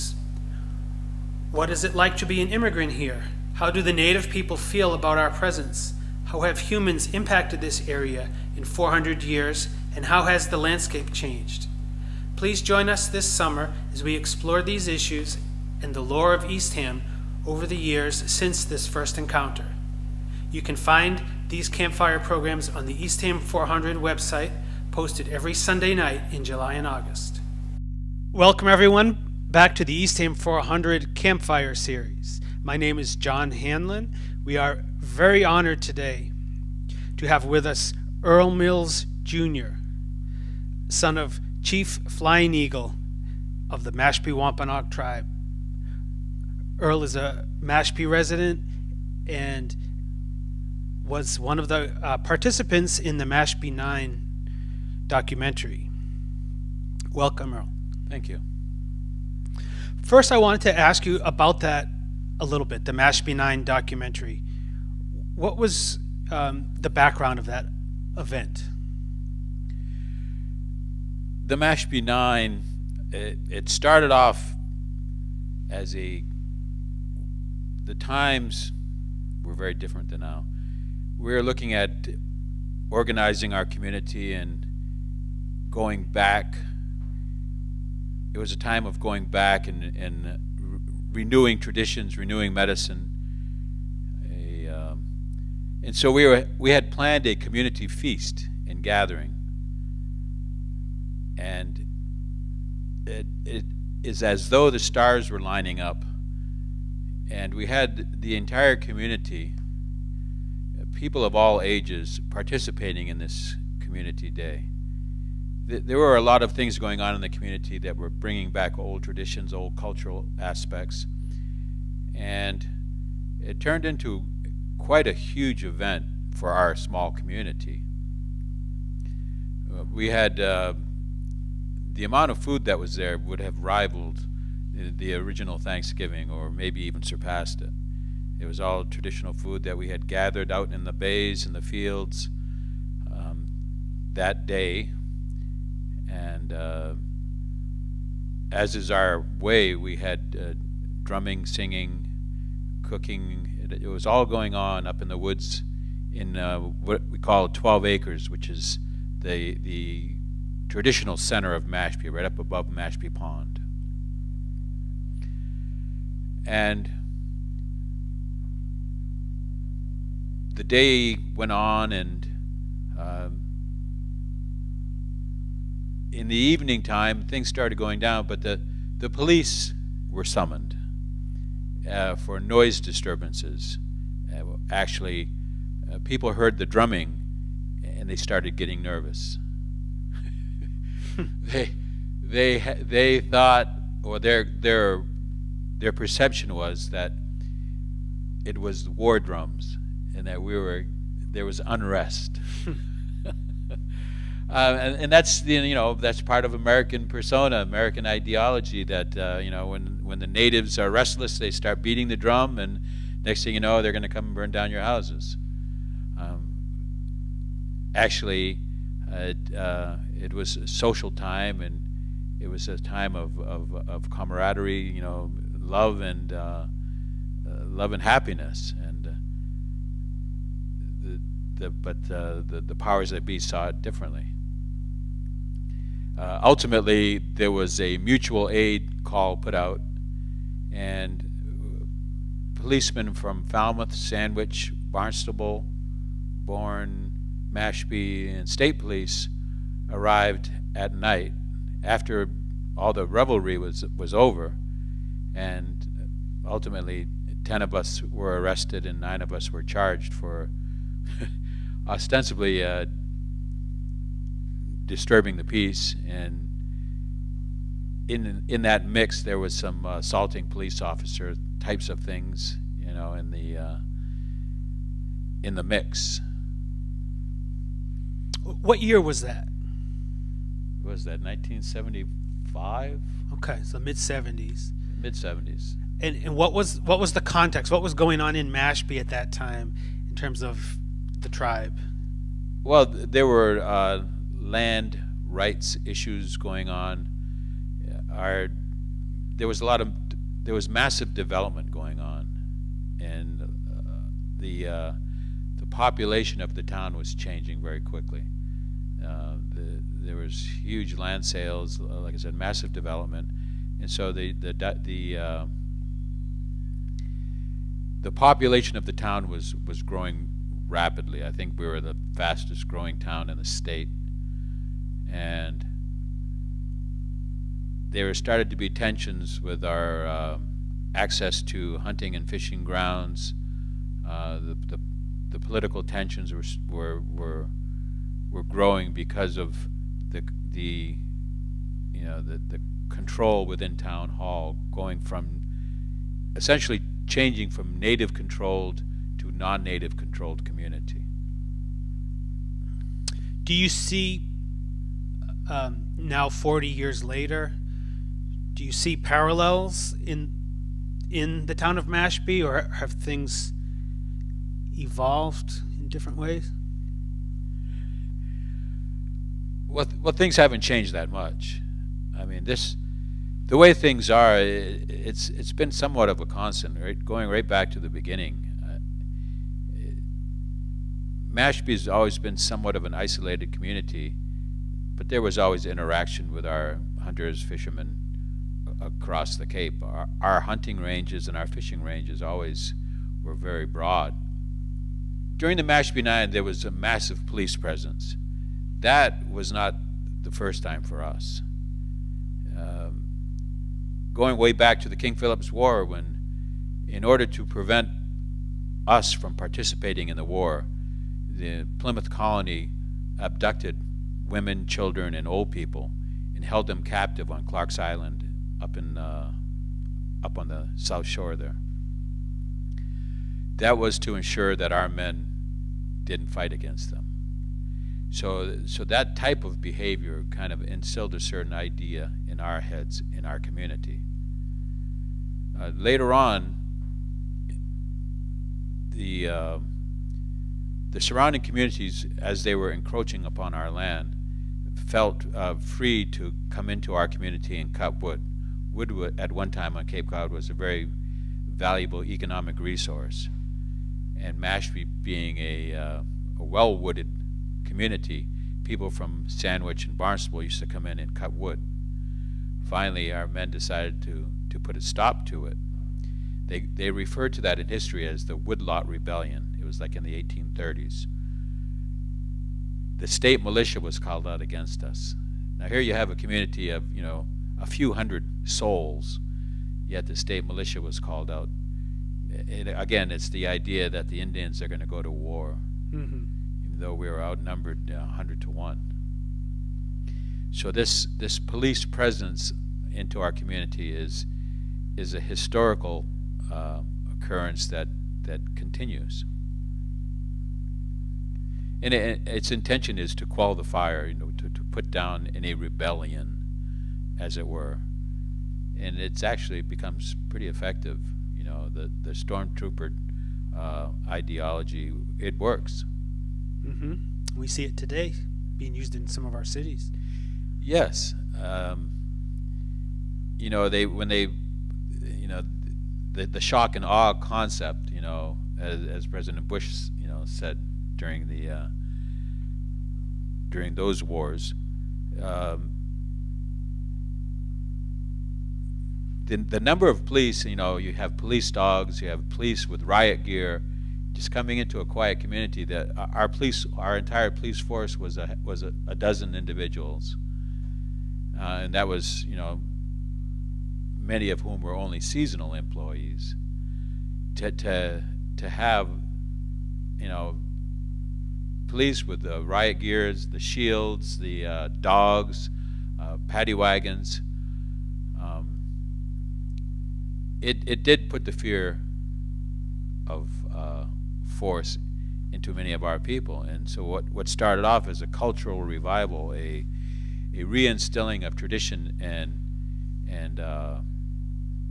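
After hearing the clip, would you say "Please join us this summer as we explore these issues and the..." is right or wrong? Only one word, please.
right.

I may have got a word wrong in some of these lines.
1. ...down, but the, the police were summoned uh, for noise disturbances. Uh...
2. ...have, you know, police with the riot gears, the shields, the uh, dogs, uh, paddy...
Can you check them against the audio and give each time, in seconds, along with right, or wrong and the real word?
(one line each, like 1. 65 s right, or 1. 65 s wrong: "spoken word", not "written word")
1. 177 s right
2. 558 s right.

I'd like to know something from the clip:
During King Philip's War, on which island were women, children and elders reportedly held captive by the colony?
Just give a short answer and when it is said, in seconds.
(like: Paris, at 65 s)
Clark's Island, at 417 s.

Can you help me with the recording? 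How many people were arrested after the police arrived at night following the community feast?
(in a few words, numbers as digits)
10.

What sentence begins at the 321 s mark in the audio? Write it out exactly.
I think we were the fastest growing town in the state.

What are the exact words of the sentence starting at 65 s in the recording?
What was um, the background of that event?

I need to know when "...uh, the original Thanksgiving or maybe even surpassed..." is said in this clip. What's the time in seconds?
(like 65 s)
134 s.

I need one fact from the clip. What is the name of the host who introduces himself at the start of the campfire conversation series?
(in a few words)
John Hanlon.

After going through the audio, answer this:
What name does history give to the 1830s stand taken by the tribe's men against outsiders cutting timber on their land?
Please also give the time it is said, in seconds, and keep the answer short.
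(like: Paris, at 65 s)
Woodlot Rebellion, at 468 s.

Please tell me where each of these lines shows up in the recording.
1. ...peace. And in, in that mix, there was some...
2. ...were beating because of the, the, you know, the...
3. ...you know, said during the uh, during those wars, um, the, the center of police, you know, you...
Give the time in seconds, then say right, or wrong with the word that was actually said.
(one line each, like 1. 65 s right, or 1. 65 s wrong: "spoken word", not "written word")
1. 265 s right
2. 338 s wrong: "growing", not "beating"
3. 529 s wrong: "number", not "center".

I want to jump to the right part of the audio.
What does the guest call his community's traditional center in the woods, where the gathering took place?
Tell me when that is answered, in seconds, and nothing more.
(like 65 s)
157 s.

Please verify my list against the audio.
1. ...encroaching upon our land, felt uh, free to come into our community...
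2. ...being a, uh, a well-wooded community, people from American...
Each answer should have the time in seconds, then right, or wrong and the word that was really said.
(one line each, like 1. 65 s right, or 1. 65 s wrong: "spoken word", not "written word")
1. 442 s right
2. 455 s wrong: "Sandwich", not "American".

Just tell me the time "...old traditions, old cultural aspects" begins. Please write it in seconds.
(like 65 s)
118 s.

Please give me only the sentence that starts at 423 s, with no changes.
That was to ensure that our men didn't fight against them.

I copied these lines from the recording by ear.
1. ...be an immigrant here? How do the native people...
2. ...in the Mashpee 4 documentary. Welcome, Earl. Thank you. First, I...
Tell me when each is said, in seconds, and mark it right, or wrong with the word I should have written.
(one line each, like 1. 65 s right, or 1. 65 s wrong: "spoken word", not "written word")
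1. 2 s right
2. 52 s wrong: "9", not "4".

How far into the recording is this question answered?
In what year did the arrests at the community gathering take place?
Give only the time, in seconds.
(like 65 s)
281 s.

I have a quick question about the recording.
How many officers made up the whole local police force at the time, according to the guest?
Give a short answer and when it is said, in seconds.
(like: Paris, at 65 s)
a dozen, at 548 s.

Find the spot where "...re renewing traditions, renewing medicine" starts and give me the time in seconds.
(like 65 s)
90 s.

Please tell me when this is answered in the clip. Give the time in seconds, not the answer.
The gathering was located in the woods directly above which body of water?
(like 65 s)
162 s.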